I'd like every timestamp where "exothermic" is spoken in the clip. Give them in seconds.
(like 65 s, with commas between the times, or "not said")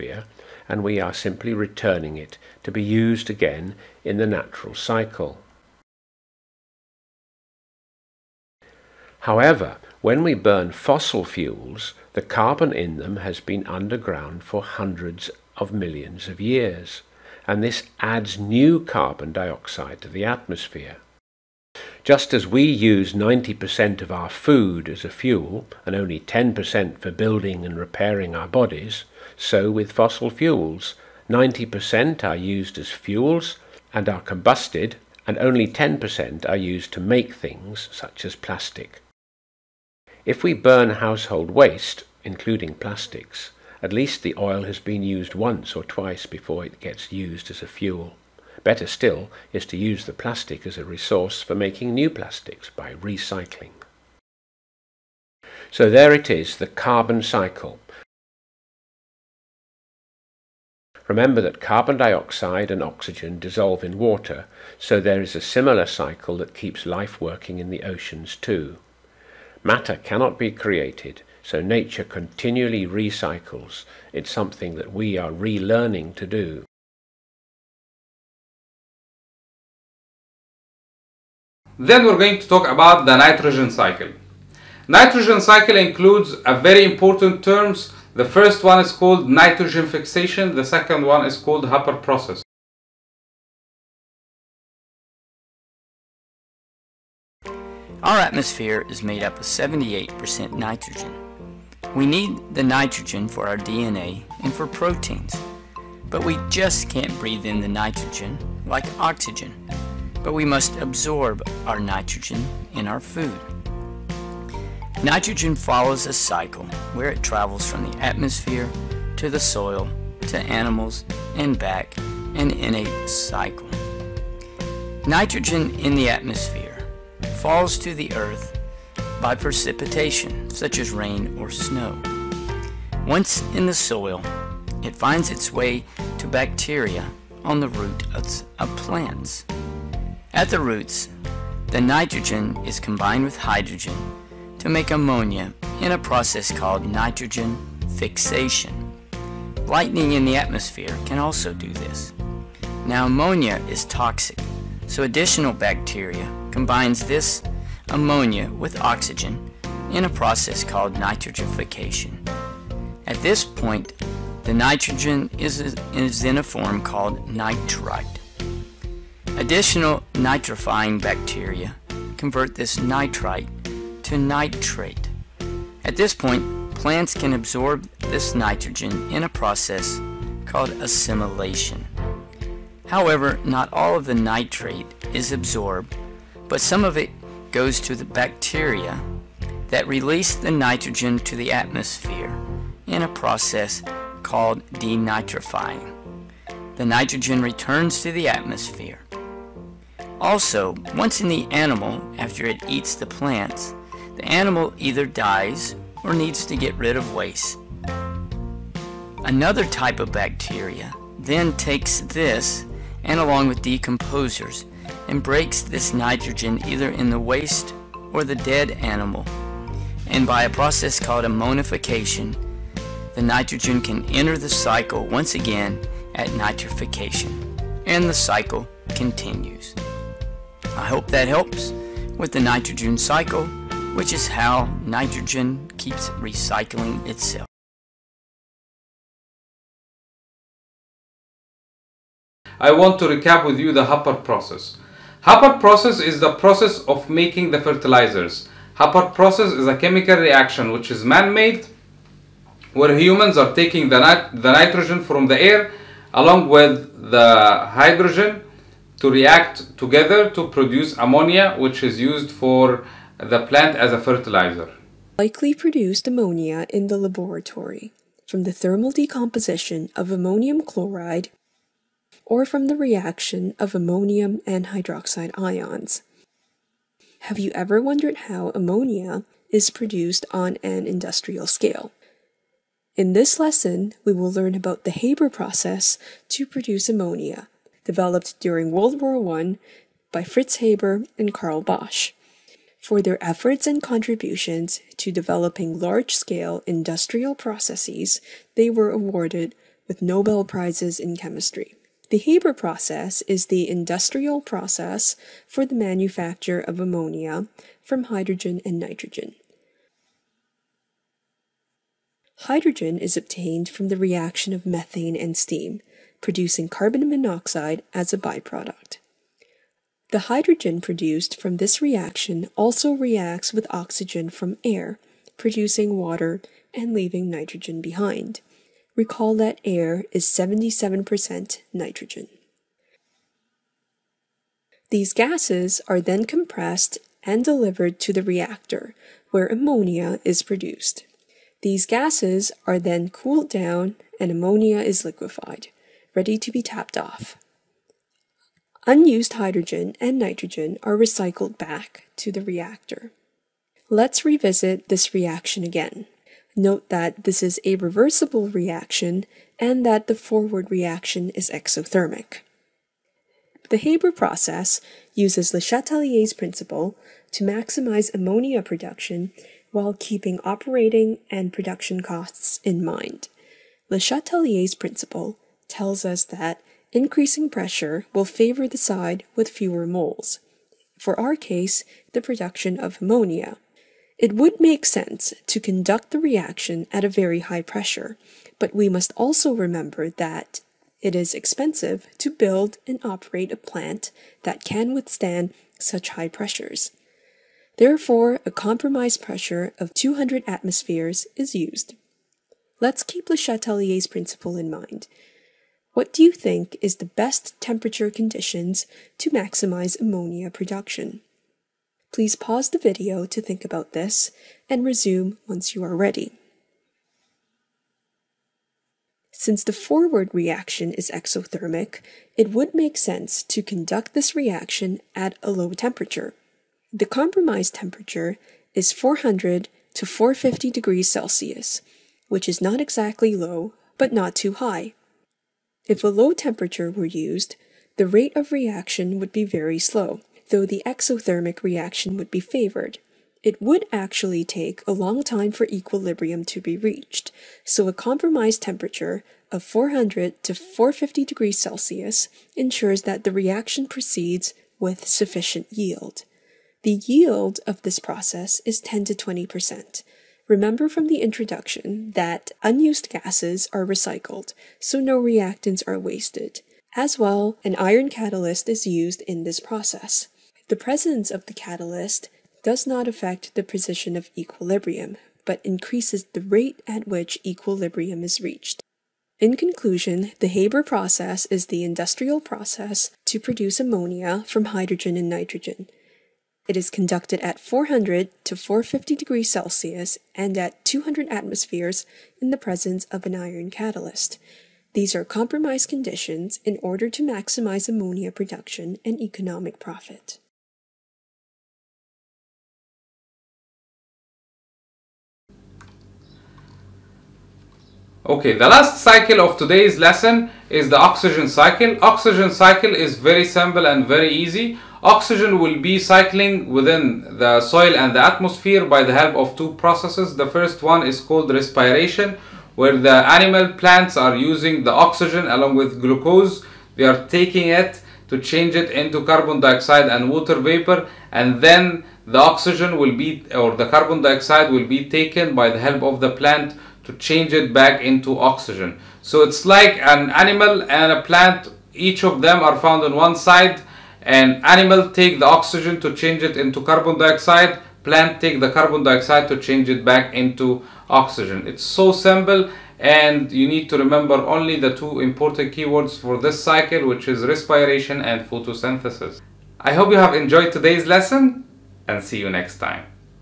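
361 s, 421 s, 440 s.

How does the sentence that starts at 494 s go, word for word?
These are compromised conditions in order to maximize ammonia production and economic profit.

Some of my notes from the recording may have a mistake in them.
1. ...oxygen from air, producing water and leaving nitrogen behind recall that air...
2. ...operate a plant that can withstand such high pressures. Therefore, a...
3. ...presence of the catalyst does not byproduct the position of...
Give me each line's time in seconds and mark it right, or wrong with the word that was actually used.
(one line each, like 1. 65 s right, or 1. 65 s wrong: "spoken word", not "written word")
1. 323 s right
2. 393 s right
3. 470 s wrong: "affect", not "byproduct".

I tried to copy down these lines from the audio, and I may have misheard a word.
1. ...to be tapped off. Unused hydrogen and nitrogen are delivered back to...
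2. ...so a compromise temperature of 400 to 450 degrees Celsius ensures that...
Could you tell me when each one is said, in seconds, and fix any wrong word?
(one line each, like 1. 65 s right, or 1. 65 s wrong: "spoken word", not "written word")
1. 346 s wrong: "recycled", not "delivered"
2. 447 s right.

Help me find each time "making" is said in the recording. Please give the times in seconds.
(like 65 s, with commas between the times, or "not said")
51 s, 247 s.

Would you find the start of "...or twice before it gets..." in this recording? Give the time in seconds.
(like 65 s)
45 s.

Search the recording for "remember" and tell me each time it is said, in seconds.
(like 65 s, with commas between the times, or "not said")
61 s, 389 s, 460 s, 553 s.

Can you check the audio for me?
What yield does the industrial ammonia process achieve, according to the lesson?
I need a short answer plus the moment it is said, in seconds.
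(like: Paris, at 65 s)
10 to 20 percent, at 458 s.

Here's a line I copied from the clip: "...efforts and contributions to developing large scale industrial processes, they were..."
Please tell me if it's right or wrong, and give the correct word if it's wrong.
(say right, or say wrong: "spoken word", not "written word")
right.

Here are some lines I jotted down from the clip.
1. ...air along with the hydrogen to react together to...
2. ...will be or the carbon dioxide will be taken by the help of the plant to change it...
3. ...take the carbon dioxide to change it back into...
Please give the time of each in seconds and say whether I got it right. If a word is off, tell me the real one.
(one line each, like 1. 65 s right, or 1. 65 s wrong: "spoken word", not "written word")
1. 255 s right
2. 532 s right
3. 548 s right.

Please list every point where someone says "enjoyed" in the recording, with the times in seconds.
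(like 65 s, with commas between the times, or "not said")
560 s.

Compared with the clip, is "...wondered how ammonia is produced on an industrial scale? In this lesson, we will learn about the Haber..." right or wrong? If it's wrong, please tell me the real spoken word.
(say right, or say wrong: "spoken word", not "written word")
right.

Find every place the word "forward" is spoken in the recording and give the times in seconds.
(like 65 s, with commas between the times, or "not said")
360 s, 419 s.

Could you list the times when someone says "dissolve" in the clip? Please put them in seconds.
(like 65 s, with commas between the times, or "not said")
63 s.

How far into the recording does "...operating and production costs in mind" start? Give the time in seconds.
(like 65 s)
370 s.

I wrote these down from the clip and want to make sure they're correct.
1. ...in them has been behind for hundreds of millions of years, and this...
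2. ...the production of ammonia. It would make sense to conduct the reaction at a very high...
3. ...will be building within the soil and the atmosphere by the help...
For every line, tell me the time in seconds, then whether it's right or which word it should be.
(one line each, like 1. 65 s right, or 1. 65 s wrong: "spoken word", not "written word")
1. 12 s wrong: "underground", not "behind"
2. 382 s right
3. 515 s wrong: "cycling", not "building".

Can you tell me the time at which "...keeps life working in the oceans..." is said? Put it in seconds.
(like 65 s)
66 s.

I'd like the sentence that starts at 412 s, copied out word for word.
Please pause the video to think about this and resume once you are ready.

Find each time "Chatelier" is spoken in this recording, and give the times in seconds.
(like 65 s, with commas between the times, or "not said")
365 s, 373 s, 403 s.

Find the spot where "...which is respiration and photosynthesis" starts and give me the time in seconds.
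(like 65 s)
557 s.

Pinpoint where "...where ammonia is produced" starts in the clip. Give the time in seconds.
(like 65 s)
339 s.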